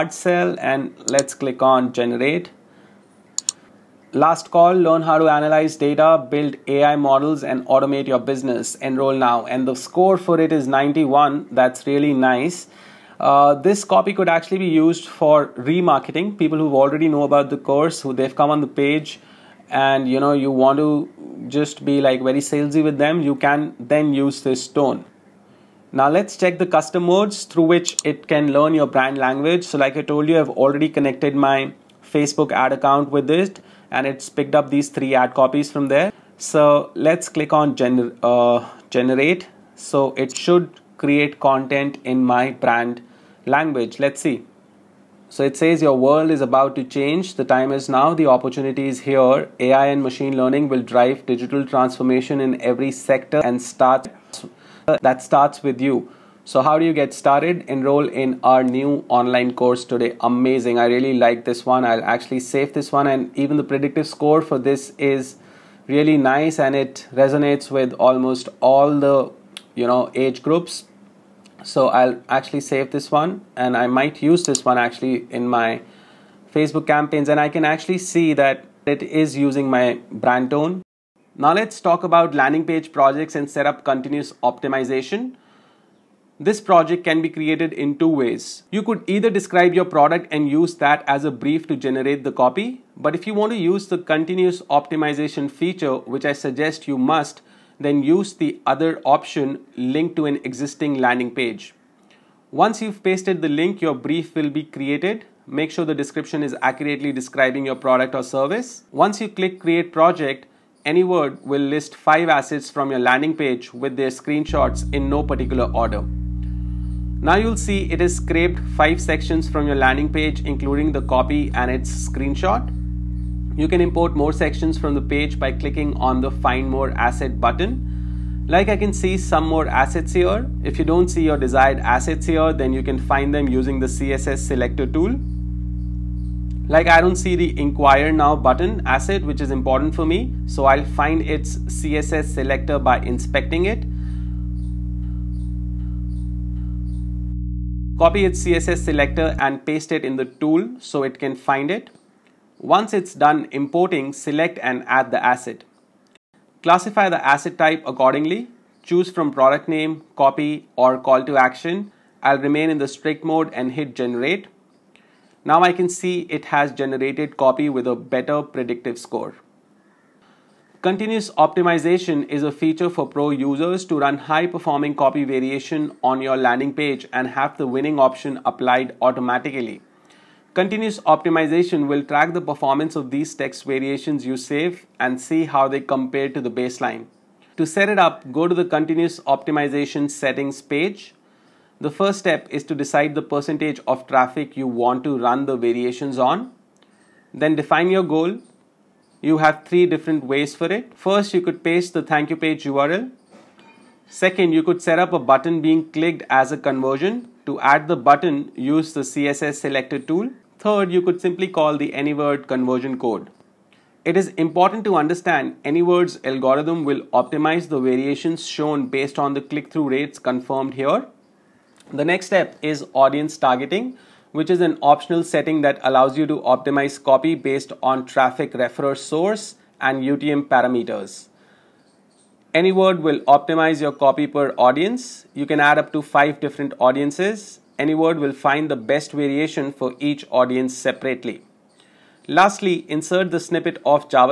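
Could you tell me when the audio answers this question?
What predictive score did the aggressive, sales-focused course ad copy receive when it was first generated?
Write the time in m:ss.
0:10.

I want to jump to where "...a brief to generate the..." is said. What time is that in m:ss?
1:31.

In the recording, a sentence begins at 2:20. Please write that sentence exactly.
So I'll find its CSS selector by inspecting it.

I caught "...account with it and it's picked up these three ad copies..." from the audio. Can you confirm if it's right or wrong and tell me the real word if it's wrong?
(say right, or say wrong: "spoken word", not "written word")
right.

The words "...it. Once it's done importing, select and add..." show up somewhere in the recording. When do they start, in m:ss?
2:31.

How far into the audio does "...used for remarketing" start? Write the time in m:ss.
0:14.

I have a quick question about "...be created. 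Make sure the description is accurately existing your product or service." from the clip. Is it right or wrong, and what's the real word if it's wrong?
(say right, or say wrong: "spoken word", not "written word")
wrong: "describing", not "existing".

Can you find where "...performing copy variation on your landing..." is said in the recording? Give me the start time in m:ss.
2:54.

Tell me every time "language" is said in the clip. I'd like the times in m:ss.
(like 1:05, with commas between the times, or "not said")
0:29, 0:43.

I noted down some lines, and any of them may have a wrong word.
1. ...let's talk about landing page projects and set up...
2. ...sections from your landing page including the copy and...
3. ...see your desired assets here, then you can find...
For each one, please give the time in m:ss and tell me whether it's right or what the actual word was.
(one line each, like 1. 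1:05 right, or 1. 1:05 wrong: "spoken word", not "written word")
1. 1:21 right
2. 1:58 right
3. 2:11 right.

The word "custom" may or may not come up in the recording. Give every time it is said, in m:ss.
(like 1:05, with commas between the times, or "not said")
0:26.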